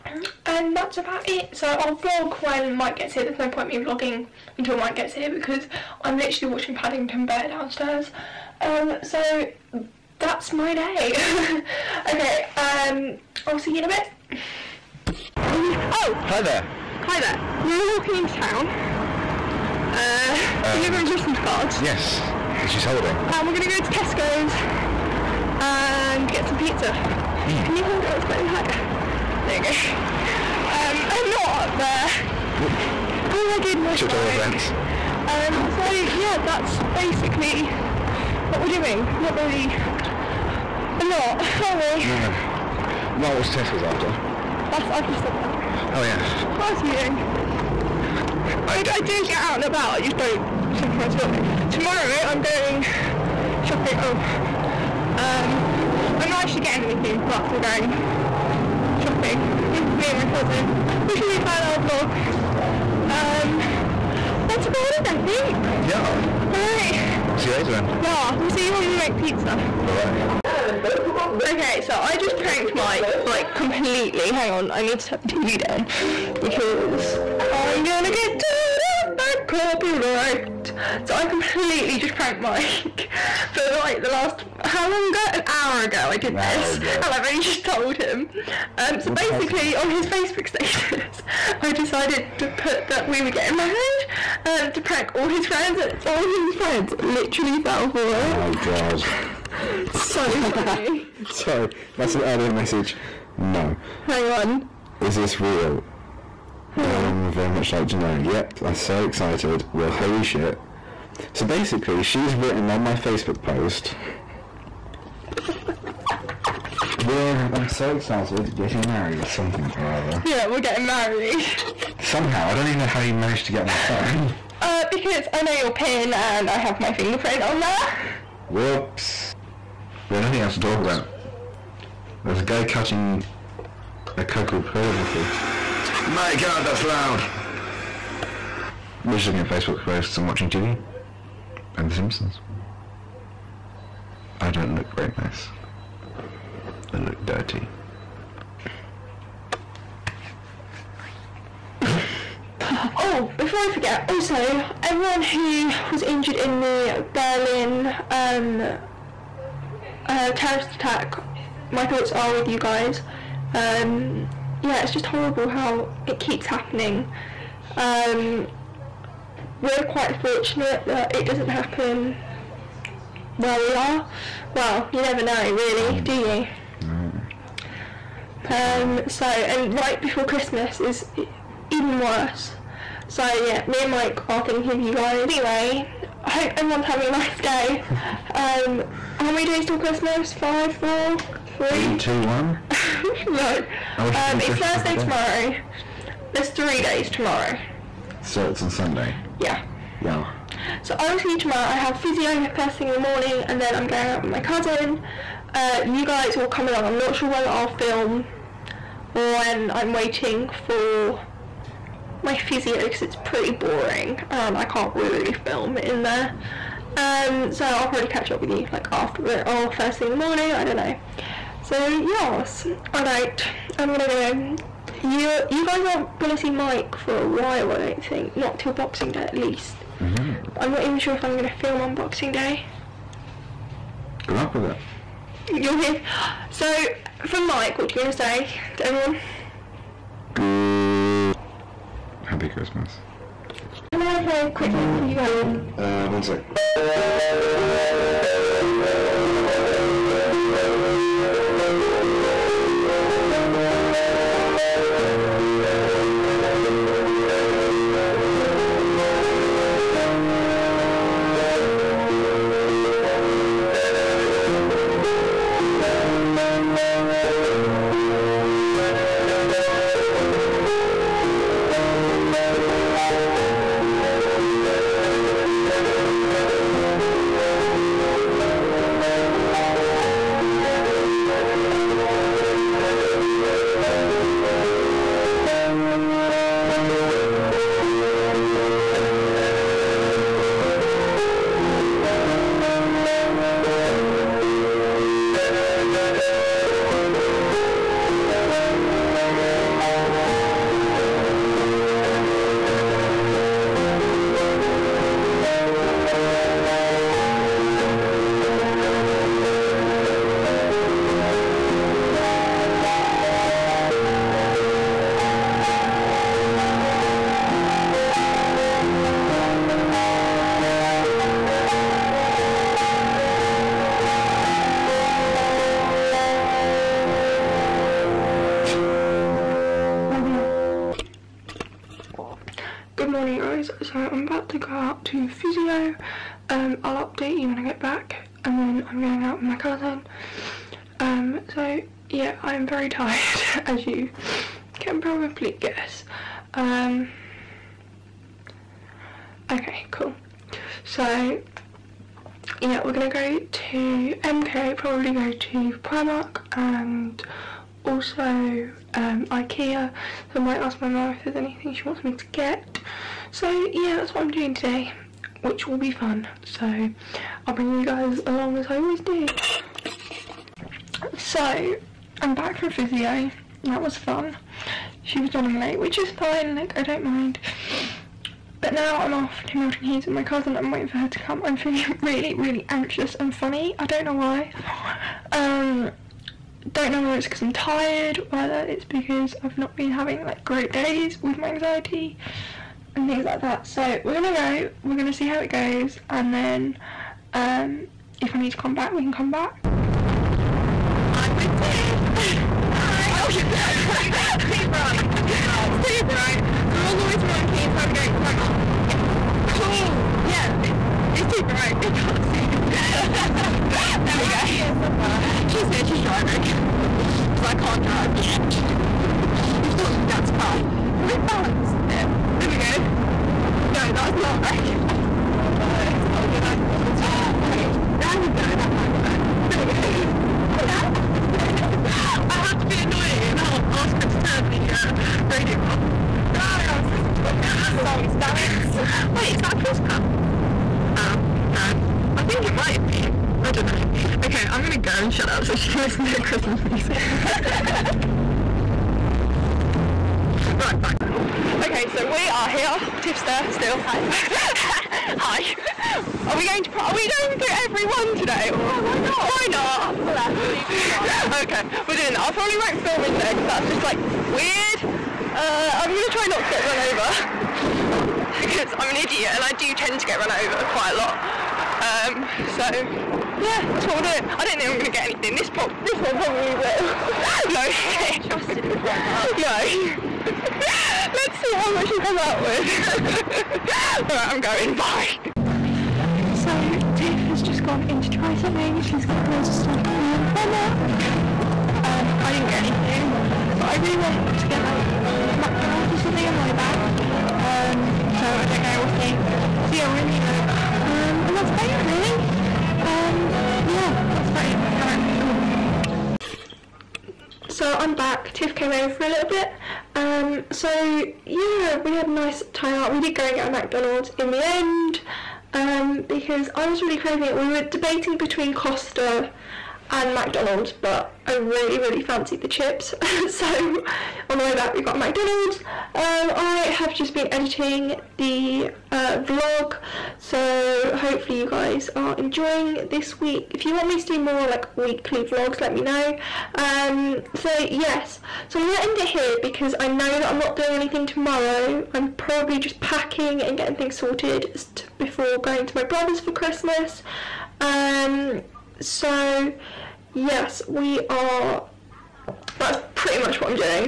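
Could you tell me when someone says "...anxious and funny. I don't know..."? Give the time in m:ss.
6:22.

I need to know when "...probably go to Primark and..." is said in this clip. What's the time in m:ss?
5:54.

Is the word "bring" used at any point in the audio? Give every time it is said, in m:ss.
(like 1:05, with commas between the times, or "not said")
6:07.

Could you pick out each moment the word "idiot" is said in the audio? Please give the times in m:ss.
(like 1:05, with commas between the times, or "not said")
7:48.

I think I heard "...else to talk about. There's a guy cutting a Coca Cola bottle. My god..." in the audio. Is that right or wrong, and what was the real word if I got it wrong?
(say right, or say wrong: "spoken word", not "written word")
right.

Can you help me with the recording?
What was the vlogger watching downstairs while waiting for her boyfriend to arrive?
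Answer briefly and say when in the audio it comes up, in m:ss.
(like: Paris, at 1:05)
Paddington Bear, at 0:06.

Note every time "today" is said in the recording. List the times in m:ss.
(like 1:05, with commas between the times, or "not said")
6:04, 7:38.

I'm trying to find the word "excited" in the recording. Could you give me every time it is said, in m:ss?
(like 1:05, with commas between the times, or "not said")
1:48, 1:57.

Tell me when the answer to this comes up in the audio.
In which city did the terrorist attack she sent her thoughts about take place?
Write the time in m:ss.
2:37.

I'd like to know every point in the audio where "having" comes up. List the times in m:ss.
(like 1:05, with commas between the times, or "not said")
3:06, 6:29.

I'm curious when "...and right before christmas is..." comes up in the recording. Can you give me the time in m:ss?
2:59.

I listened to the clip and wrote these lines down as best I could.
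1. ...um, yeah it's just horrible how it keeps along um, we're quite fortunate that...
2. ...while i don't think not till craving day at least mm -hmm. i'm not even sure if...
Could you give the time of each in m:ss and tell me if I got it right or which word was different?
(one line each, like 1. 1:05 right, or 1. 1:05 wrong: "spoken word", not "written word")
1. 2:43 wrong: "happening", not "along"
2. 3:47 wrong: "boxing", not "craving".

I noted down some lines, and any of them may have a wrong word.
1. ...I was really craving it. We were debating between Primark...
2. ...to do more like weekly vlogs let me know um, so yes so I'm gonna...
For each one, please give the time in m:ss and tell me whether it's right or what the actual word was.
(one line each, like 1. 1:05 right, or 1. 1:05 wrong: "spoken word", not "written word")
1. 8:36 wrong: "Costa", not "Primark"
2. 8:53 right.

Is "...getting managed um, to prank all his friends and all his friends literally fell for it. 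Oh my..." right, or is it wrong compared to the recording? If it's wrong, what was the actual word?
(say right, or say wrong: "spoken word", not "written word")
wrong: "married", not "managed".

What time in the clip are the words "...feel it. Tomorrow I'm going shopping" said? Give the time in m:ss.
0:51.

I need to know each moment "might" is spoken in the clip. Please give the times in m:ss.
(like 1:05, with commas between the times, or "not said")
6:00, 7:08, 7:22.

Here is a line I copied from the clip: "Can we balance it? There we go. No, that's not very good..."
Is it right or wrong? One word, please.
right.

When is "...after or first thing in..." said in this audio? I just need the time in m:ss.
3:38.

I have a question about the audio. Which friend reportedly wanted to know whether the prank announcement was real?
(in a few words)
Darren.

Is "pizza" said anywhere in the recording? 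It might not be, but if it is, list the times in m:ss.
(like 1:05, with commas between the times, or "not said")
0:26, 1:09.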